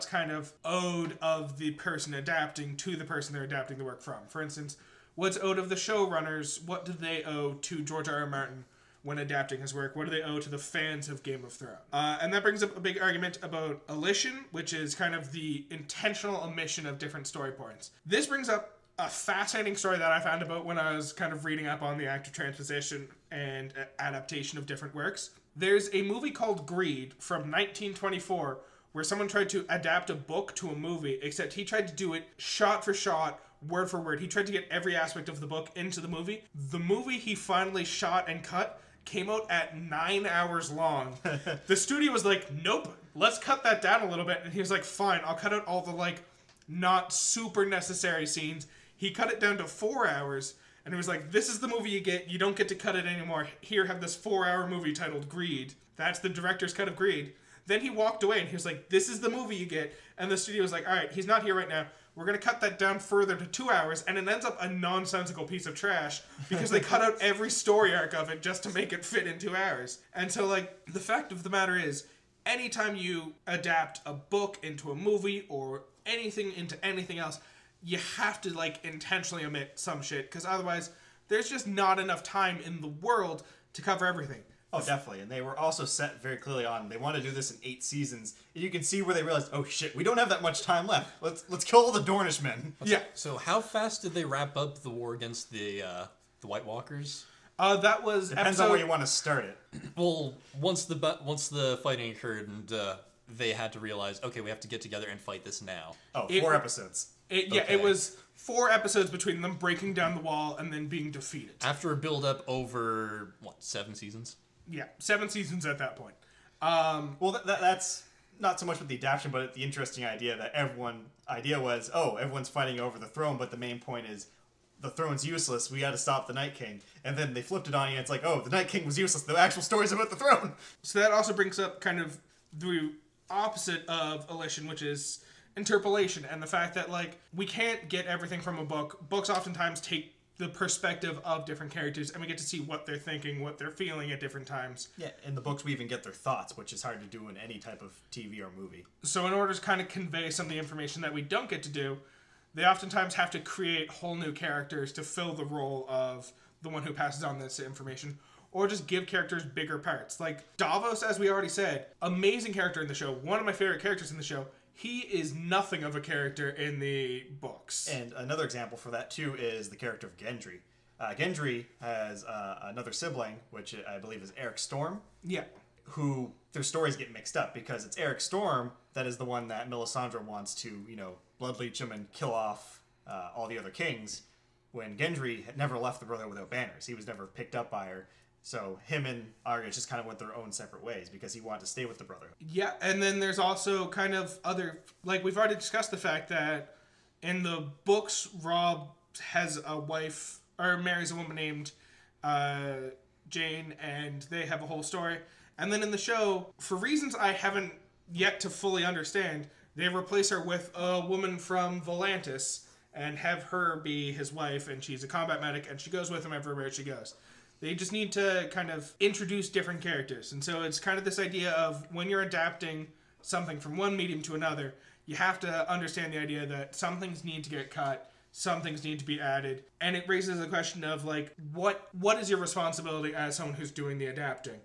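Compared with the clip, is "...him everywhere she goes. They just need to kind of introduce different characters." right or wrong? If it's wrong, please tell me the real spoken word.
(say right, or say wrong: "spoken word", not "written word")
right.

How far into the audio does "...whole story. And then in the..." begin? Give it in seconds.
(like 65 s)
204 s.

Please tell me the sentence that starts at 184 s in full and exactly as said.
When Gendry had never left the Brotherhood without banners, he was never picked up by her.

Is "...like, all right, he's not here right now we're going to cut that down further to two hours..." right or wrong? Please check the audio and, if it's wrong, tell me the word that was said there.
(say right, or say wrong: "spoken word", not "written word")
right.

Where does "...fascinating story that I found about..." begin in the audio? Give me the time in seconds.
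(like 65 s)
19 s.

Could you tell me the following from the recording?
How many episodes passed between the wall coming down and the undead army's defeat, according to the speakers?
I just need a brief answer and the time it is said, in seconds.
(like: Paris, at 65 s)
4, at 108 s.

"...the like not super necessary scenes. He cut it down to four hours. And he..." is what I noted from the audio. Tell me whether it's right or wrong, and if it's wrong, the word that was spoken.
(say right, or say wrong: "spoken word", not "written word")
right.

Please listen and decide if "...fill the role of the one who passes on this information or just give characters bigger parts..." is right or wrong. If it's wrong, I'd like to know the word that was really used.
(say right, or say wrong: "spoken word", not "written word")
right.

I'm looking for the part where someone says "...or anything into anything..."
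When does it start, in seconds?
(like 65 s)
75 s.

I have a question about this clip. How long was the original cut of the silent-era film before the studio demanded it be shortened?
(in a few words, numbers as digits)
9 hours.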